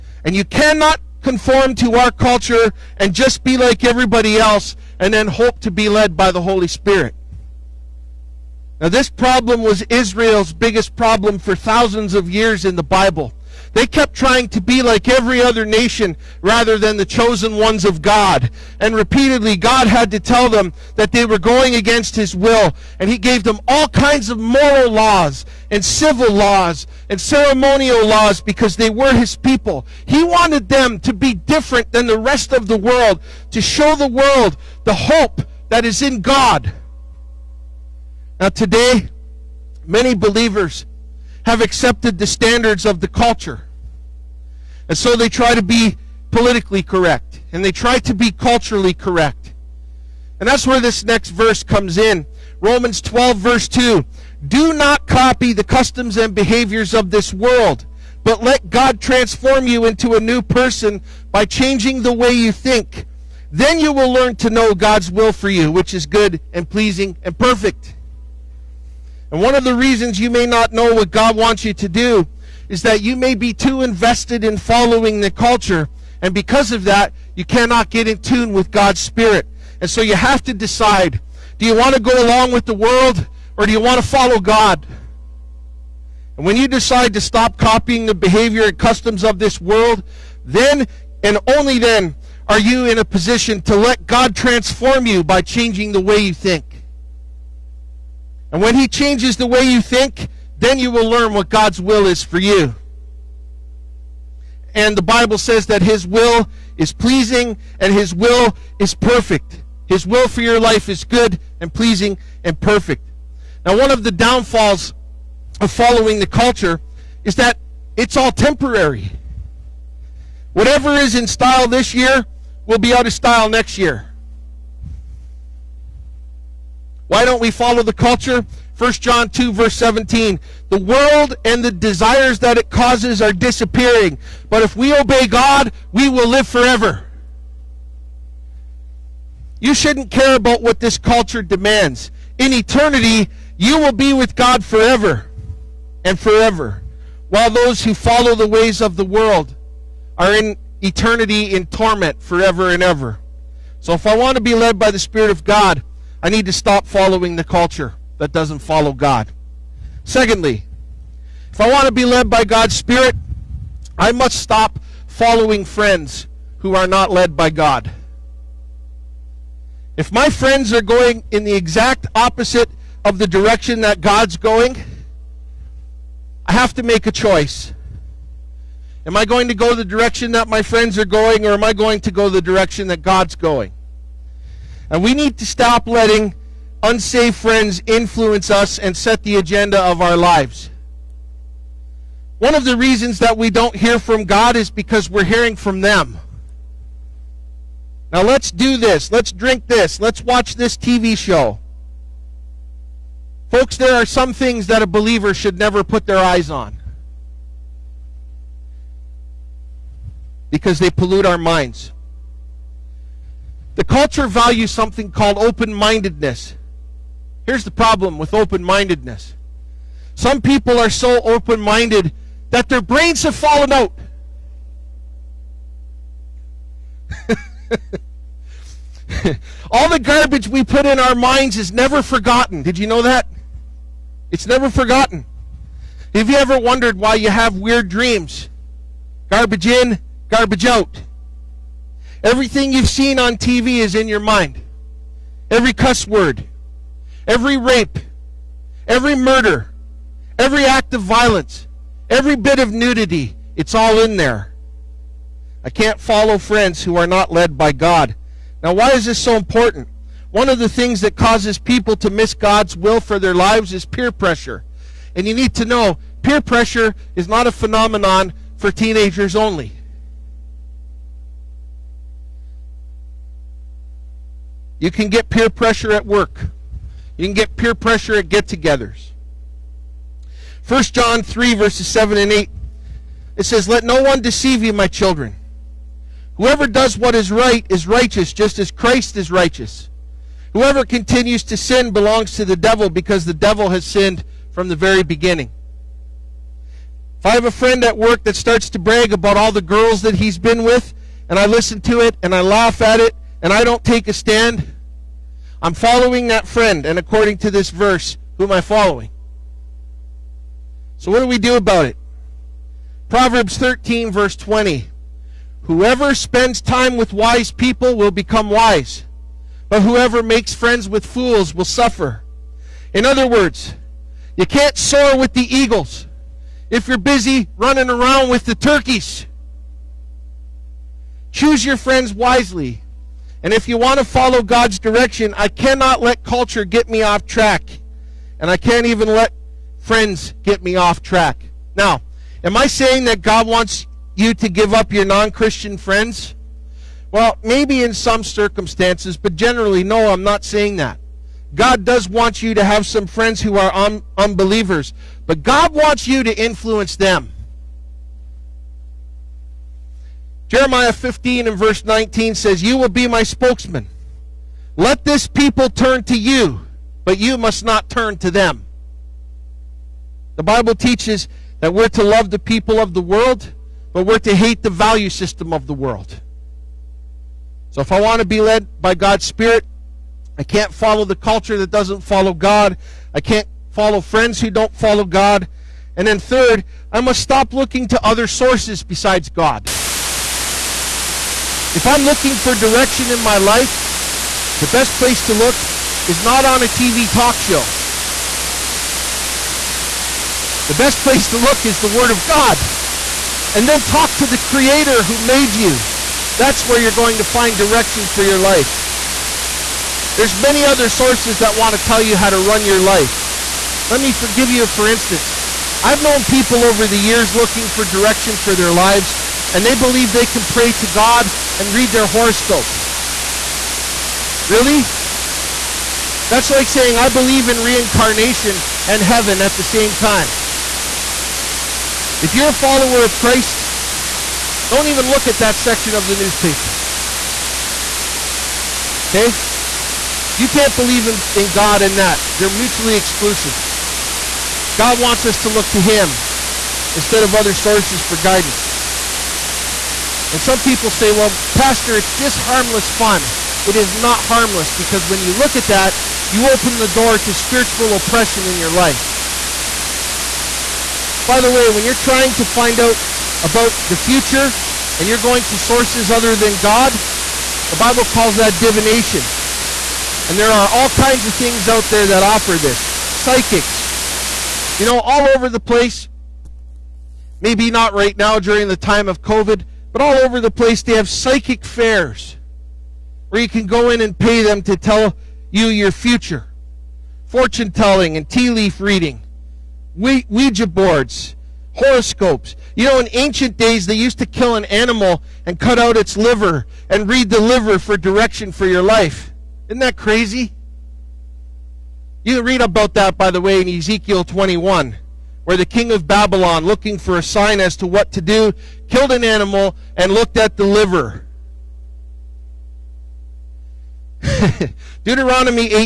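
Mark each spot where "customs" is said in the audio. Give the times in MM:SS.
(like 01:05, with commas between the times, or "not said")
00:55, 01:28.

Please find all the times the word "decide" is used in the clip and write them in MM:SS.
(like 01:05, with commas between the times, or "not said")
01:20, 01:26.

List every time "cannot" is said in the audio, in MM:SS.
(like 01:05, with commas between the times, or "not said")
00:00, 01:17, 05:35.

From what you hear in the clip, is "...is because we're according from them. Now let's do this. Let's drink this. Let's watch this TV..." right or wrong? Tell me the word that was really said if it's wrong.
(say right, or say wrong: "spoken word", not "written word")
wrong: "hearing", not "according".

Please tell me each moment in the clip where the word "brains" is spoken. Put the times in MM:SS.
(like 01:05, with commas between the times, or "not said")
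03:42.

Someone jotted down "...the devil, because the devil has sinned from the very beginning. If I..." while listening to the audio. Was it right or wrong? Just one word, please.
right.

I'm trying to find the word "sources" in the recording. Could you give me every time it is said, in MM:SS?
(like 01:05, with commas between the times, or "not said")
06:28, 06:50, 07:27, 07:45.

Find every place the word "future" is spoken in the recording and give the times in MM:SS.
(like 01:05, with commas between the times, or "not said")
07:43, 08:05.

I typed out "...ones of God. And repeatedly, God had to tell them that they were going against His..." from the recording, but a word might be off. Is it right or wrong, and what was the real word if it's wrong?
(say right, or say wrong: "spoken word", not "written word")
right.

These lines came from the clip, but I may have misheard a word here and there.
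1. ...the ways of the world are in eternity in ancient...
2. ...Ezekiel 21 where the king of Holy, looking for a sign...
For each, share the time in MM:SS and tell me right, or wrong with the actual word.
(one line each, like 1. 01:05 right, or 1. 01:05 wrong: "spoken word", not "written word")
1. 02:28 wrong: "torment", not "ancient"
2. 08:23 wrong: "Babylon", not "Holy".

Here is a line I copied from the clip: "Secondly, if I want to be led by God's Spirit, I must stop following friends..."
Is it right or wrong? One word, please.
right.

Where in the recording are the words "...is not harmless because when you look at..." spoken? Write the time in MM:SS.
07:33.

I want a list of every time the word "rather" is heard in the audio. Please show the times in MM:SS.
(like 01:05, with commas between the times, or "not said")
00:16.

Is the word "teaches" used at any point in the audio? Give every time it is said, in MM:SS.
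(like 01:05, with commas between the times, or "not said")
06:10.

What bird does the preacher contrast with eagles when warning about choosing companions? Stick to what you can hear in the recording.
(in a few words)
Turkeys.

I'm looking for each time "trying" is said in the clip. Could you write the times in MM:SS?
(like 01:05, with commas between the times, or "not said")
00:14, 07:41.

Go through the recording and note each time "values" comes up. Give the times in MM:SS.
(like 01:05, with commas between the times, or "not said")
03:34, 06:14.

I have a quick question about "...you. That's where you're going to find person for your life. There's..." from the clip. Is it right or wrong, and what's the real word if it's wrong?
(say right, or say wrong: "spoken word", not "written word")
wrong: "direction", not "person".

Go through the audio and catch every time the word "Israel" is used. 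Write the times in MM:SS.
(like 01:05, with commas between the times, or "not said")
00:09.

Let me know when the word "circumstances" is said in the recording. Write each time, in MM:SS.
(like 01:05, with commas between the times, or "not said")
05:48.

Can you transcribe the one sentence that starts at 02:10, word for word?
The world and the desires that it causes are disappearing.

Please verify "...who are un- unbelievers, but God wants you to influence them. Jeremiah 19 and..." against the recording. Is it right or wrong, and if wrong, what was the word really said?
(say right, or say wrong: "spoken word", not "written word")
wrong: "15", not "19".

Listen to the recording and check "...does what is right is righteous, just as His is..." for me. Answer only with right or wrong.
wrong.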